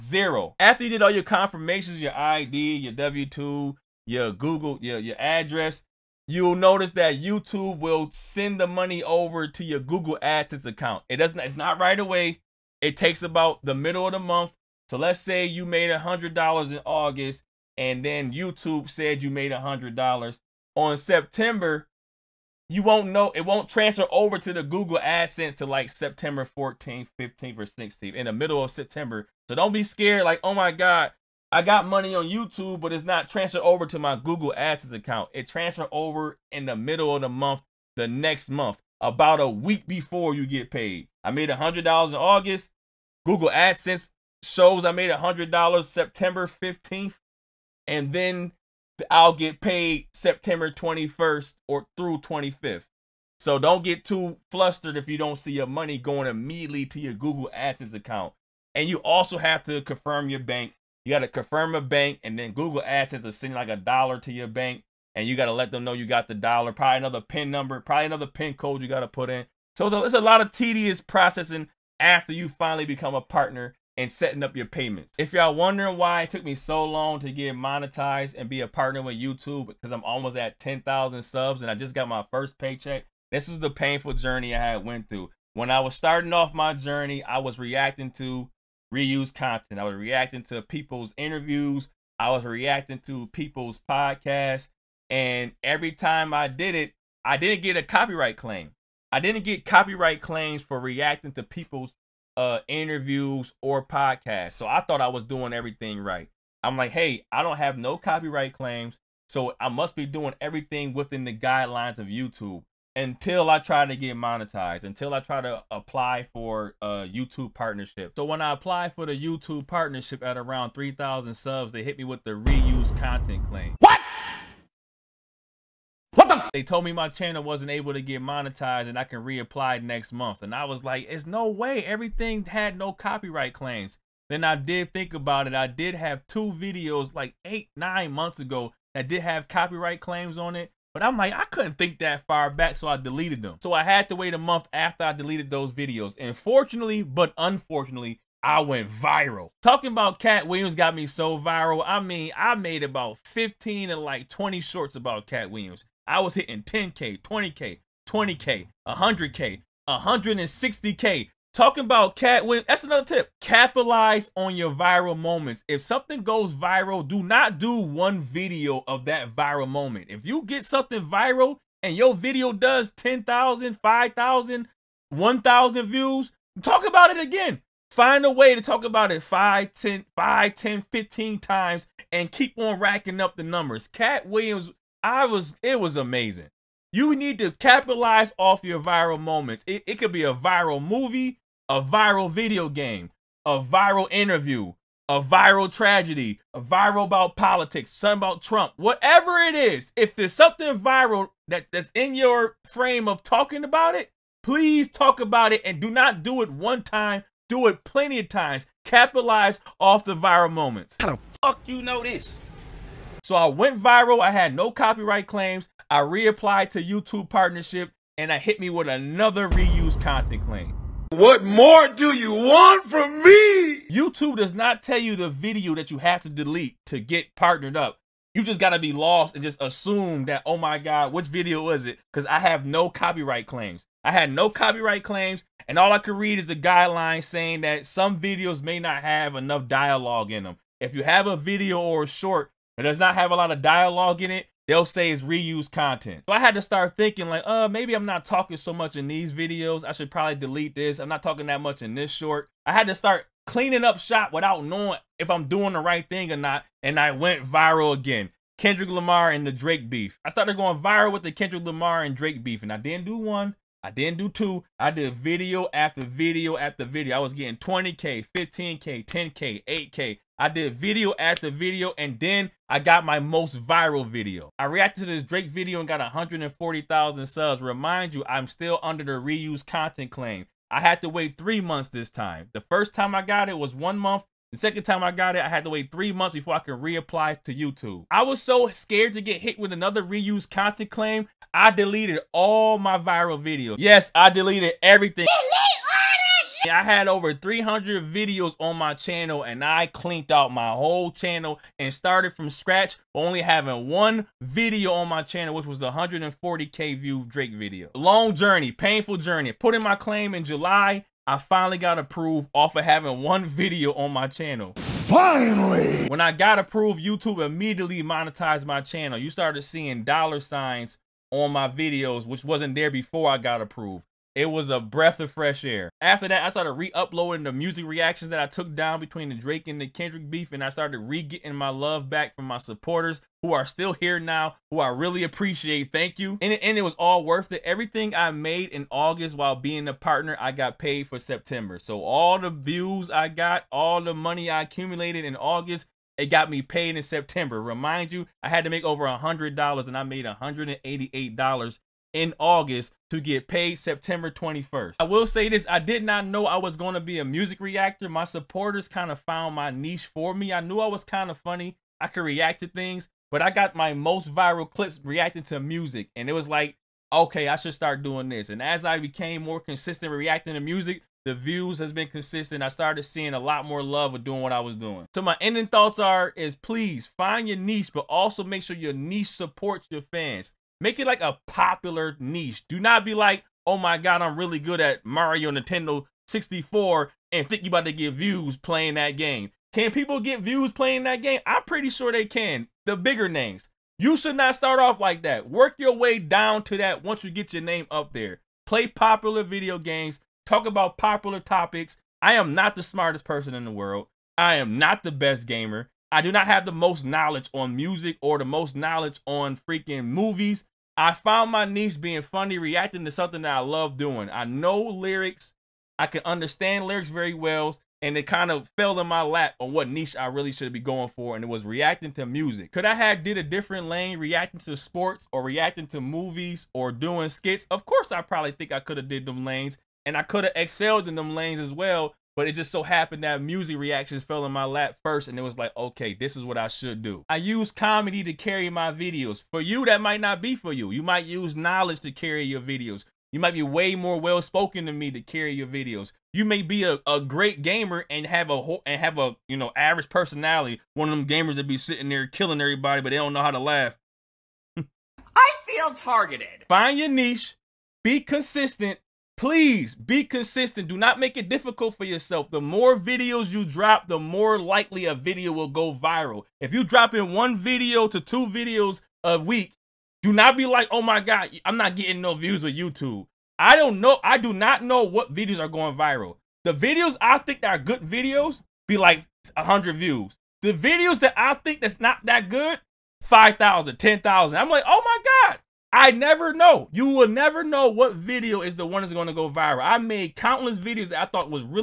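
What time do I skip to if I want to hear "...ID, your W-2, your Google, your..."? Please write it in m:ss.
0:02.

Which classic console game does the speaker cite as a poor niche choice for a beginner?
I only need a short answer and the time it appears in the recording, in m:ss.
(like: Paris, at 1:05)
Mario Nintendo 64, at 6:25.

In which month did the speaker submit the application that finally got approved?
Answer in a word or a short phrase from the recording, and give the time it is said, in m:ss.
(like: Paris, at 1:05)
July, at 5:10.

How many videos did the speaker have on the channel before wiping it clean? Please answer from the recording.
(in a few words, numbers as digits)
300.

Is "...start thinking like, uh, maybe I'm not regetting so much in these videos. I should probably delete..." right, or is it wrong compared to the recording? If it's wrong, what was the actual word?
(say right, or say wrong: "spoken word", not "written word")
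wrong: "talking", not "regetting".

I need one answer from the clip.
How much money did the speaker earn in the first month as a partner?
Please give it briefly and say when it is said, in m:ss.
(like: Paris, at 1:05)
$188, at 5:50.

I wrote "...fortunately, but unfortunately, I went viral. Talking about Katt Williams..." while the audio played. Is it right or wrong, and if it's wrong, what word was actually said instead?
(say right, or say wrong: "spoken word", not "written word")
right.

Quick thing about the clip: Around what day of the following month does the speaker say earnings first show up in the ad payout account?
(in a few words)
15th.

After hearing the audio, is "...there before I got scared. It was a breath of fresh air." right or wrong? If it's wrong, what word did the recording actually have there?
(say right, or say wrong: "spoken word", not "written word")
wrong: "approved", not "scared".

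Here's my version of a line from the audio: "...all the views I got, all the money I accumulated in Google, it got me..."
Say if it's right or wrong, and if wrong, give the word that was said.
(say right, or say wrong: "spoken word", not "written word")
wrong: "August", not "Google".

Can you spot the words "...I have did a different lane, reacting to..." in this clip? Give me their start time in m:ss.
7:02.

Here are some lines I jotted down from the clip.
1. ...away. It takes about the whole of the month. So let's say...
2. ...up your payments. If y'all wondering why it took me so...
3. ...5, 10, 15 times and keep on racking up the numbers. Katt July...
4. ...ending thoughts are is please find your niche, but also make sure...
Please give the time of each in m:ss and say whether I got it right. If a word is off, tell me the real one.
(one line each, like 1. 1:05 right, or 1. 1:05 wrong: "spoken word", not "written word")
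1. 0:11 wrong: "middle", not "whole"
2. 1:14 right
3. 3:00 wrong: "Williams", not "July"
4. 6:15 right.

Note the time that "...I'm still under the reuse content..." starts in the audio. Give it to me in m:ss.
4:38.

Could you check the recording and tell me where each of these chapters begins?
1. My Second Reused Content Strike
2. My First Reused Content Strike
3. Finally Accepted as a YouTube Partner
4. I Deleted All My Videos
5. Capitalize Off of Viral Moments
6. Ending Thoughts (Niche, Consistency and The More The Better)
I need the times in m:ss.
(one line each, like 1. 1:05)
1. 3:32
2. 1:14
3. 5:07
4. 4:47
5. 2:22
6. 6:14.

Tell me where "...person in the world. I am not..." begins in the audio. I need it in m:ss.
6:43.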